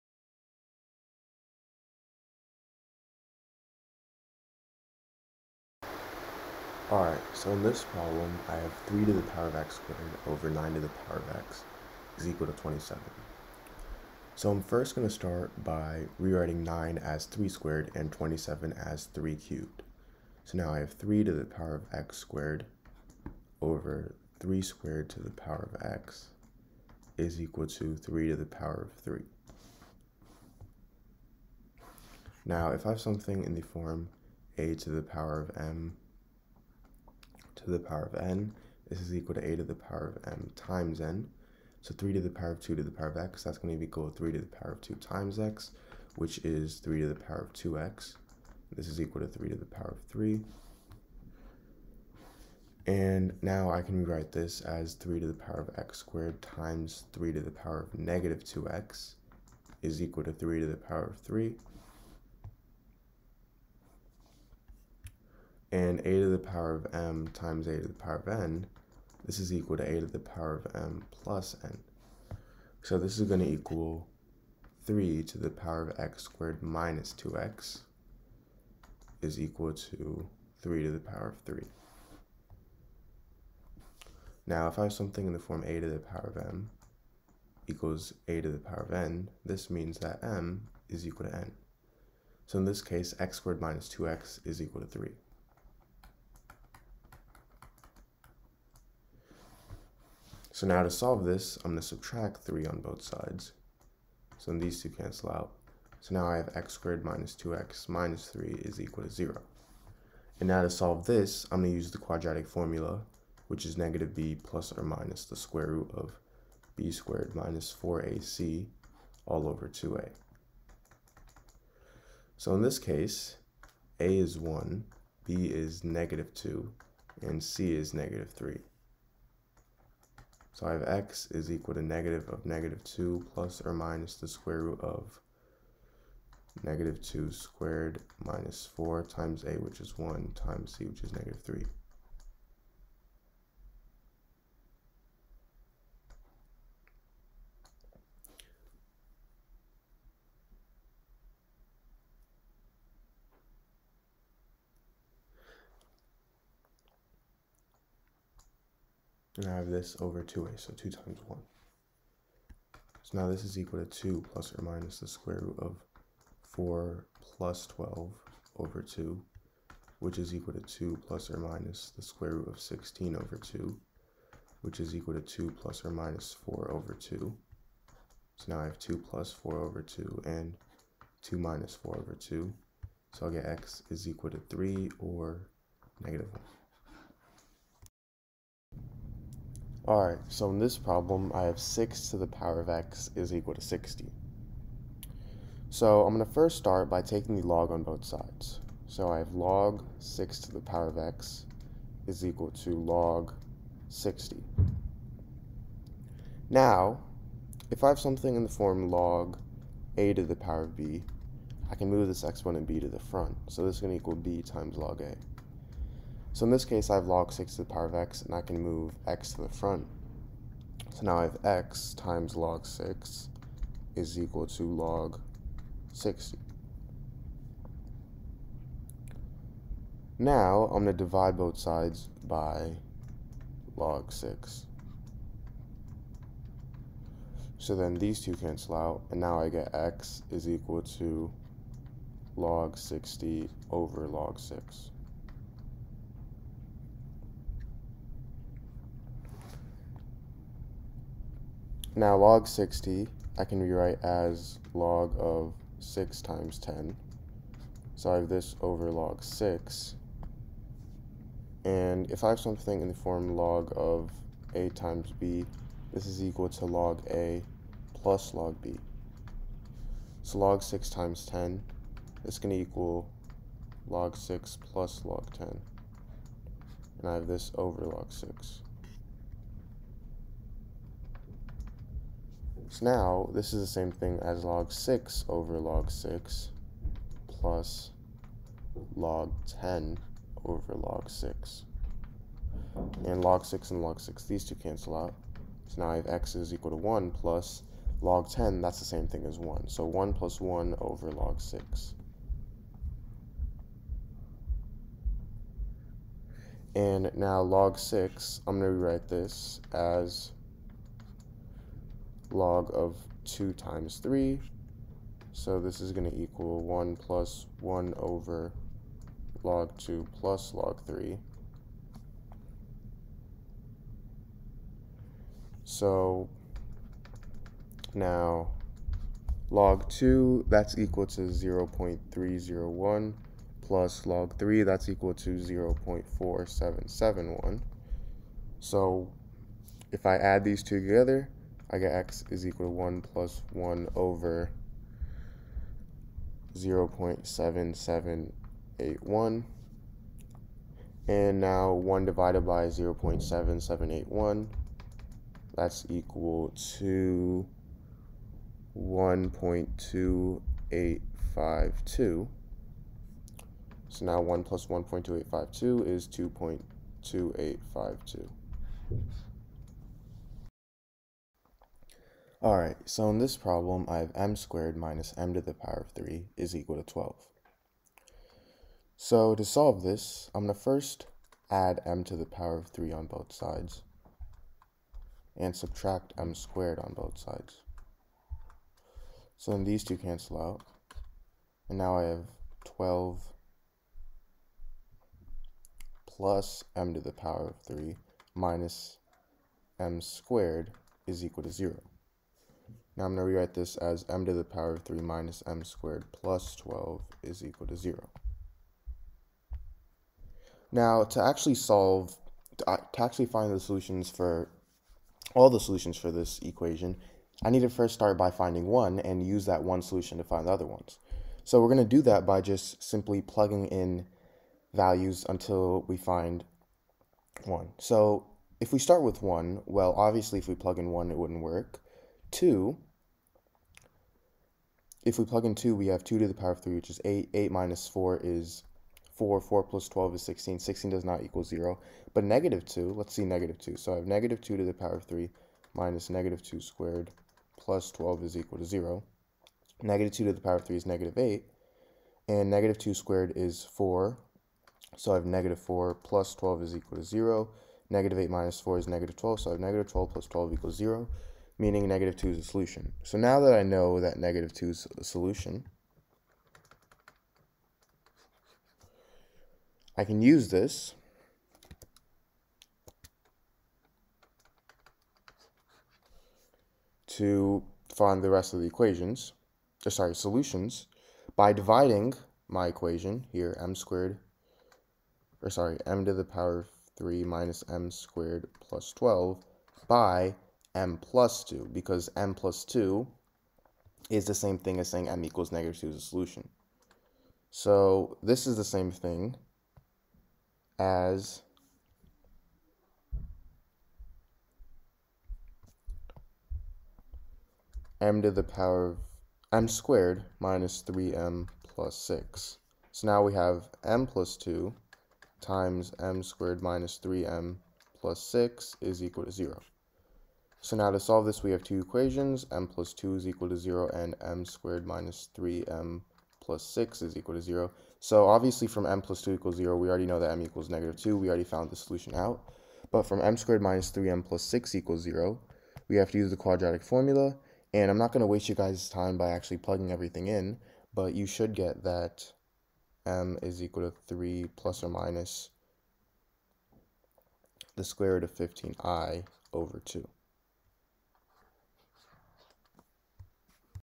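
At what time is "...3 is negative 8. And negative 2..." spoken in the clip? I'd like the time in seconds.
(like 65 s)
450 s.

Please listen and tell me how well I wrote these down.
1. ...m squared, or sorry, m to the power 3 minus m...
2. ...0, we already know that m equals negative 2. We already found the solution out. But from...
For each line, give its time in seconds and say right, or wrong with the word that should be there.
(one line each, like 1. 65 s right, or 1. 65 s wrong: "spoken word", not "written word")
1. 483 s right
2. 529 s right.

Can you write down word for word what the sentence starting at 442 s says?
But negative 2, let's see negative 2.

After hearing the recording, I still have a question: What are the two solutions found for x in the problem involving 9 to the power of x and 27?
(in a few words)
3 or -1.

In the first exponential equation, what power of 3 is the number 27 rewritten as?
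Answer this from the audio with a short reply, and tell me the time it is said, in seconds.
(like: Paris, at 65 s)
3 cubed, at 19 s.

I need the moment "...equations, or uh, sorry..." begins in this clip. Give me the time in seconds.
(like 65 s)
478 s.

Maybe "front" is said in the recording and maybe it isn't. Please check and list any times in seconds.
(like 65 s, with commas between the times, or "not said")
212 s, 219 s.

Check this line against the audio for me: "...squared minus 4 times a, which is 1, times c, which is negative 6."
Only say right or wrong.
wrong.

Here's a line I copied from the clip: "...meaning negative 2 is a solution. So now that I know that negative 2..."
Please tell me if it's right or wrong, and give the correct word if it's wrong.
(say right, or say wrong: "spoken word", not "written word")
right.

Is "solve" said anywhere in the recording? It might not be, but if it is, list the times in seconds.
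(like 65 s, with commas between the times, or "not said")
100 s, 110 s, 379 s, 411 s, 520 s.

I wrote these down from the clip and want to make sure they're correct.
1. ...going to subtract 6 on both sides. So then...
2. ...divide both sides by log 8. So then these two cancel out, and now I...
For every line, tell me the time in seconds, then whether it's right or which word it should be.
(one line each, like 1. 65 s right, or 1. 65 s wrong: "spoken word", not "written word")
1. 101 s wrong: "3", not "6"
2. 231 s wrong: "6", not "8".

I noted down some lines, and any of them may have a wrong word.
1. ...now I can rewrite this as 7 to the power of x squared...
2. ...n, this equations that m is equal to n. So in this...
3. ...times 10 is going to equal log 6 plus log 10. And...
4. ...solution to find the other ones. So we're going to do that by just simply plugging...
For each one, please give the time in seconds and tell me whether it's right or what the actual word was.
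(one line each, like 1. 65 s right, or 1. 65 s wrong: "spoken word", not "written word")
1. 53 s wrong: "3", not "7"
2. 88 s wrong: "means", not "equations"
3. 270 s right
4. 419 s right.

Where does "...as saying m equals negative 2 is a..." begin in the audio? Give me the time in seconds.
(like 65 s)
494 s.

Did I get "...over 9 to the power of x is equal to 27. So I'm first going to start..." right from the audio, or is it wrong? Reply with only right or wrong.
right.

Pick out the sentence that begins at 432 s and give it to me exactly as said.
2, if we plug in 2, we have 2 to the power of 3, which is 8.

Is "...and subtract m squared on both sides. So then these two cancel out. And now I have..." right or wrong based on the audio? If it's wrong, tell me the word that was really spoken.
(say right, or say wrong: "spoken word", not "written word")
right.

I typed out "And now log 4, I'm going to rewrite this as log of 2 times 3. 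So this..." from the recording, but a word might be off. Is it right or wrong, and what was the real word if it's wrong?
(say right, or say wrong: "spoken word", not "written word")
wrong: "6", not "4".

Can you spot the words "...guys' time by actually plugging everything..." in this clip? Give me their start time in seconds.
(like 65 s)
538 s.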